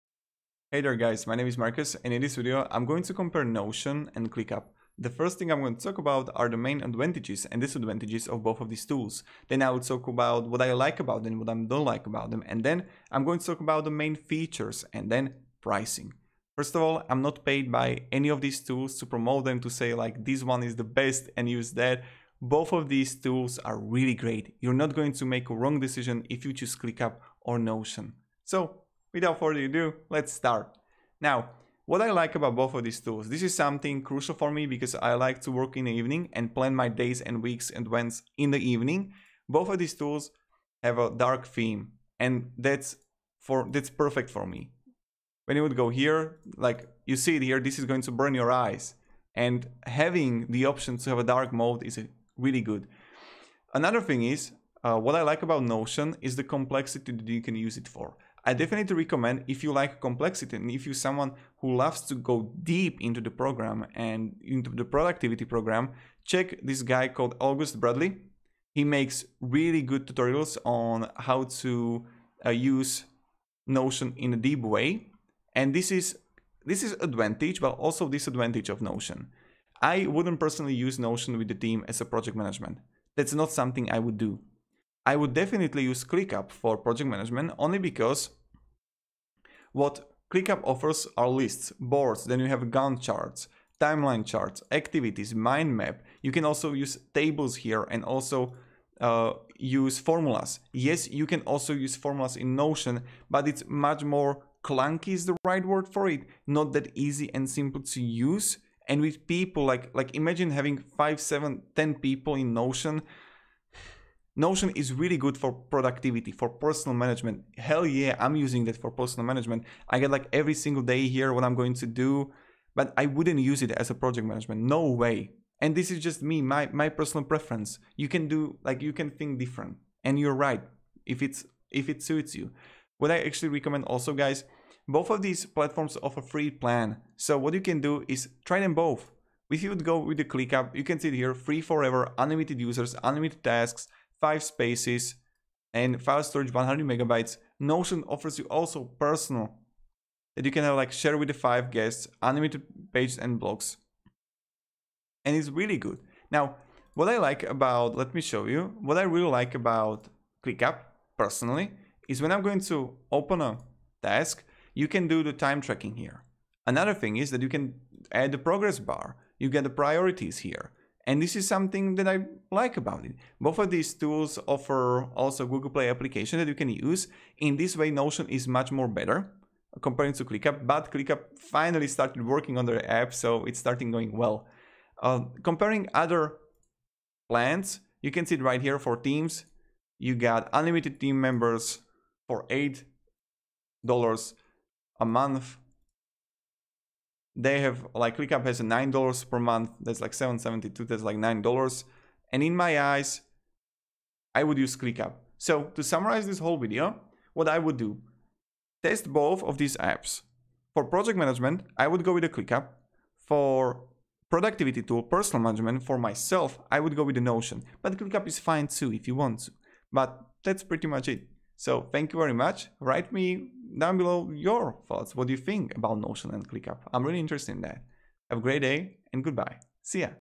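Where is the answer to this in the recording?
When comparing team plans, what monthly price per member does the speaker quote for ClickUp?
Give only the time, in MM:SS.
03:18.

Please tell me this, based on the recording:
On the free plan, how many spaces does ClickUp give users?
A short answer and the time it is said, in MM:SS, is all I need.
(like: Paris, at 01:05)
5, at 02:24.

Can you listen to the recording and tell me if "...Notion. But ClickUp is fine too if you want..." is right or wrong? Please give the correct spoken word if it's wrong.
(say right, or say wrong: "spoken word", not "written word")
right.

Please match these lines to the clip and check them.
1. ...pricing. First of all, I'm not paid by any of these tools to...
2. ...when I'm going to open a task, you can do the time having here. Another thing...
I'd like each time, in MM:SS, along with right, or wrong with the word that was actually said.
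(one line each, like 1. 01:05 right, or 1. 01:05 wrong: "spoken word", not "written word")
1. 00:15 right
2. 02:42 wrong: "tracking", not "having".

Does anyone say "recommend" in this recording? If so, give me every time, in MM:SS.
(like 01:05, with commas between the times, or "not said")
00:58, 02:13.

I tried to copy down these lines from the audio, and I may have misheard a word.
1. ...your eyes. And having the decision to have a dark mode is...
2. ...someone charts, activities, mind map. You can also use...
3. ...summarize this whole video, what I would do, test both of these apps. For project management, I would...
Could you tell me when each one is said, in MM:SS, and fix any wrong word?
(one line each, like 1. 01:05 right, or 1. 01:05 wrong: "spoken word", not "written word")
1. 00:48 wrong: "option", not "decision"
2. 01:33 wrong: "timeline", not "someone"
3. 03:25 right.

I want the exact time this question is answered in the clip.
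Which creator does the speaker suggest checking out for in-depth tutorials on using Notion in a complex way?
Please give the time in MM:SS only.
01:07.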